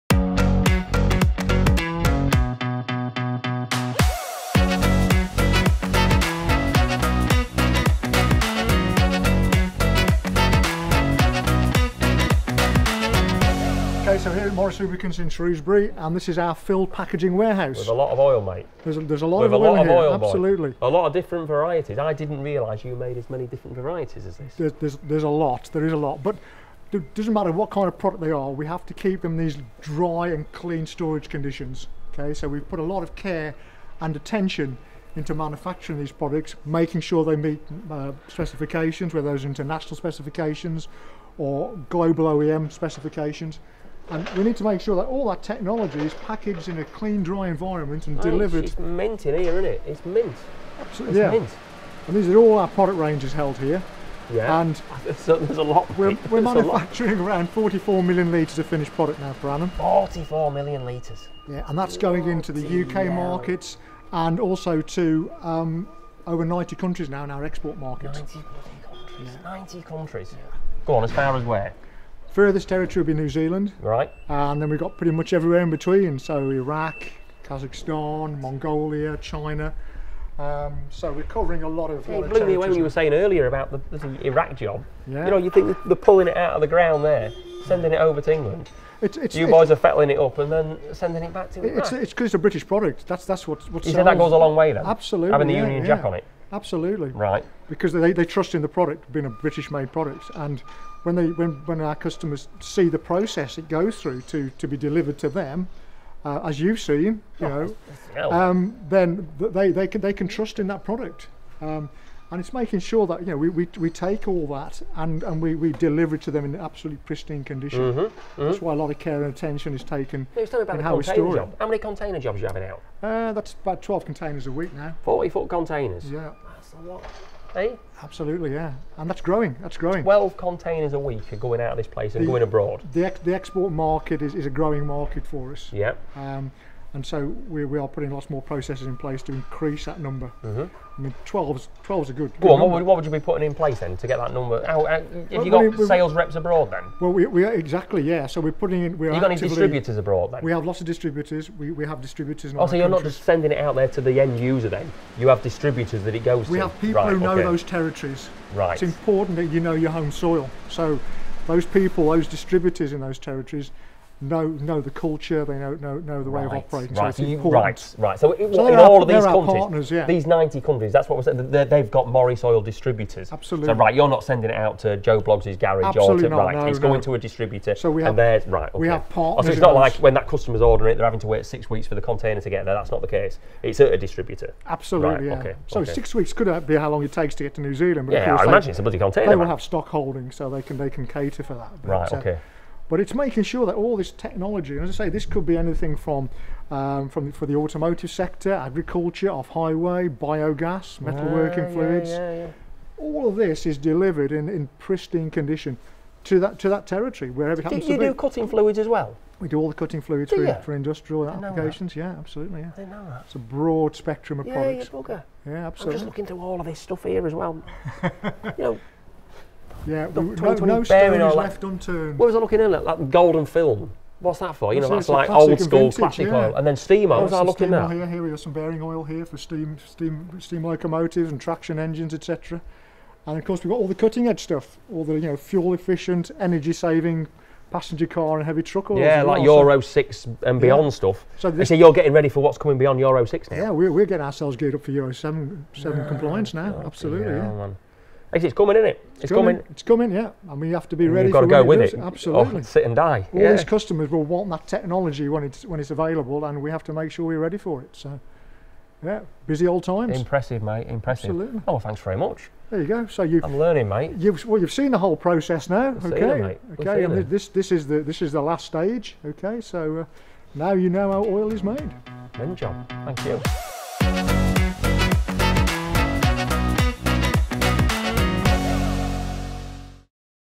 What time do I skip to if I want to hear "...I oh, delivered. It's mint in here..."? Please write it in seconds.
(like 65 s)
48 s.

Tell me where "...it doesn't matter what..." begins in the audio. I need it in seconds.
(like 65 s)
26 s.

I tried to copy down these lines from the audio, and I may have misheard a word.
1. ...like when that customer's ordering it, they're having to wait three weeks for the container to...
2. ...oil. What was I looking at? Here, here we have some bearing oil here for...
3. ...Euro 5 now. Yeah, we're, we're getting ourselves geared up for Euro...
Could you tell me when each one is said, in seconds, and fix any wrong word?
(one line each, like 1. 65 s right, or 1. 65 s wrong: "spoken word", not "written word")
1. 179 s wrong: "six", not "three"
2. 227 s right
3. 242 s wrong: "6", not "5".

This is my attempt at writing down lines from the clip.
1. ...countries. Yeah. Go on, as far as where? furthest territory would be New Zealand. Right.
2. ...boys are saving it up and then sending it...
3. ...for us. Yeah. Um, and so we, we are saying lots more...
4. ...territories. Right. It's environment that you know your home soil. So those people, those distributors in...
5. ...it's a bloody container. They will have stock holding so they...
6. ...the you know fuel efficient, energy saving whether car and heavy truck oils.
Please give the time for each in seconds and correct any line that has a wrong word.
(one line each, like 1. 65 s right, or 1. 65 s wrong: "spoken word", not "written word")
1. 69 s right
2. 89 s wrong: "fettling", not "saving"
3. 135 s wrong: "putting", not "saying"
4. 157 s wrong: "important", not "environment"
5. 188 s right
6. 235 s wrong: "passenger", not "whether".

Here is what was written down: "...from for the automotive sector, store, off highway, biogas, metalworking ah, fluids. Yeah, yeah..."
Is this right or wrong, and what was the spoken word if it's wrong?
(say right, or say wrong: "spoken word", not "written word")
wrong: "agriculture", not "store".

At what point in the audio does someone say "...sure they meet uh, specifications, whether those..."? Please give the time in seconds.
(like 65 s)
37 s.